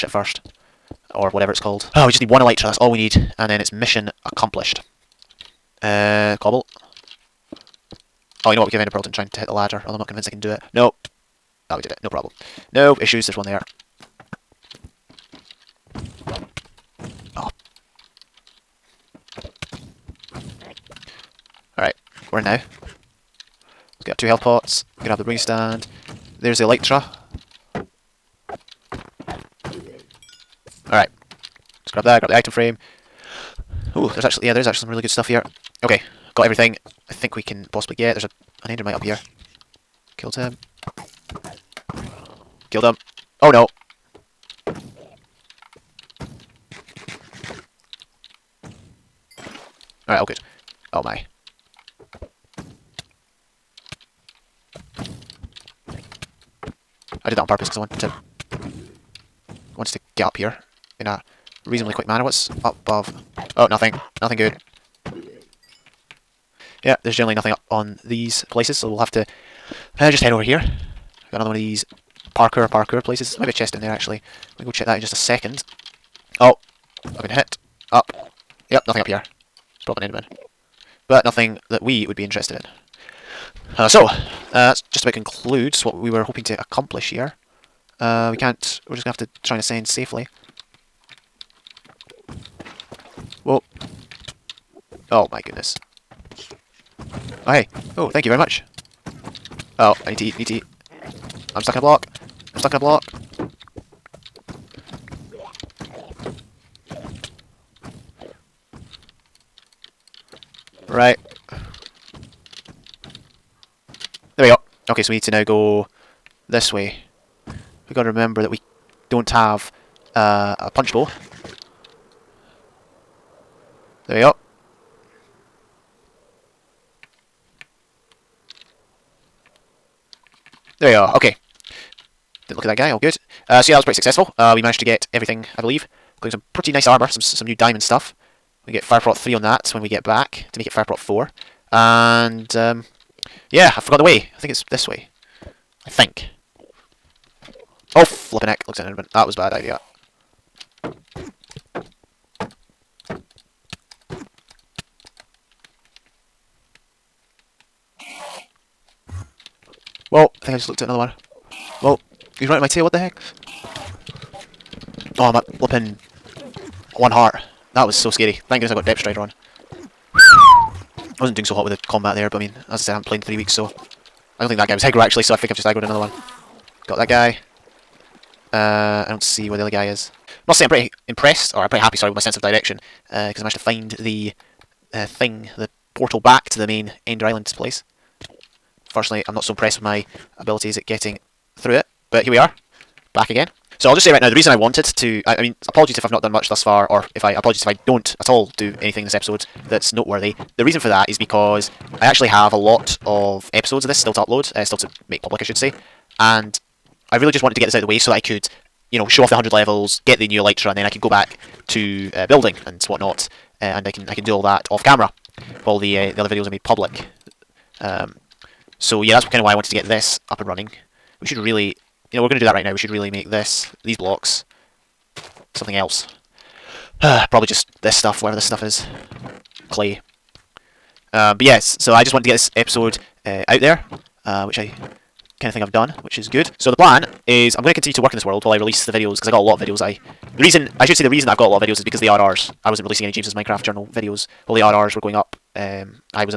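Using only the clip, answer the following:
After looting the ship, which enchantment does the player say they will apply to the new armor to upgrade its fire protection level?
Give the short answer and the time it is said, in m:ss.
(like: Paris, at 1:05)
Fireprot 3, at 2:18.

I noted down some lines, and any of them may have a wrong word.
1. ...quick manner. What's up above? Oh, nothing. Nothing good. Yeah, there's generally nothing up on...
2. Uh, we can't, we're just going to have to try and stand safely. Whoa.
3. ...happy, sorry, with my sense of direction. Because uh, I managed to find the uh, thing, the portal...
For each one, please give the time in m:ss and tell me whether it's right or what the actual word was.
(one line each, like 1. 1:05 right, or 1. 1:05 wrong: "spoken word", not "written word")
1. 1:01 right
2. 1:27 wrong: "ascend", not "stand"
3. 3:01 right.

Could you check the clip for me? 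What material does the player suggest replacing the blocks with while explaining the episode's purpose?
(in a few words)
clay.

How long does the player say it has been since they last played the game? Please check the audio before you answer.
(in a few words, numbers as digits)
three weeks.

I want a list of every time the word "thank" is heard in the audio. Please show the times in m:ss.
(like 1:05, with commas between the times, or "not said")
1:38, 2:48.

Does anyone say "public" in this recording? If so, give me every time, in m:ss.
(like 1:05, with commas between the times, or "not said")
3:25, 3:36.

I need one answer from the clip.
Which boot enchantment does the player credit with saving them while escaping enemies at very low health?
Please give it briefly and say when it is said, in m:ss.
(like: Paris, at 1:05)
Depth Strider, at 2:48.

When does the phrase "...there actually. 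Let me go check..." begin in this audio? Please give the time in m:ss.
1:13.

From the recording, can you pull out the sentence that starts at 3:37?
Um, so yeah, that's kind of why I wanted to get this up and running.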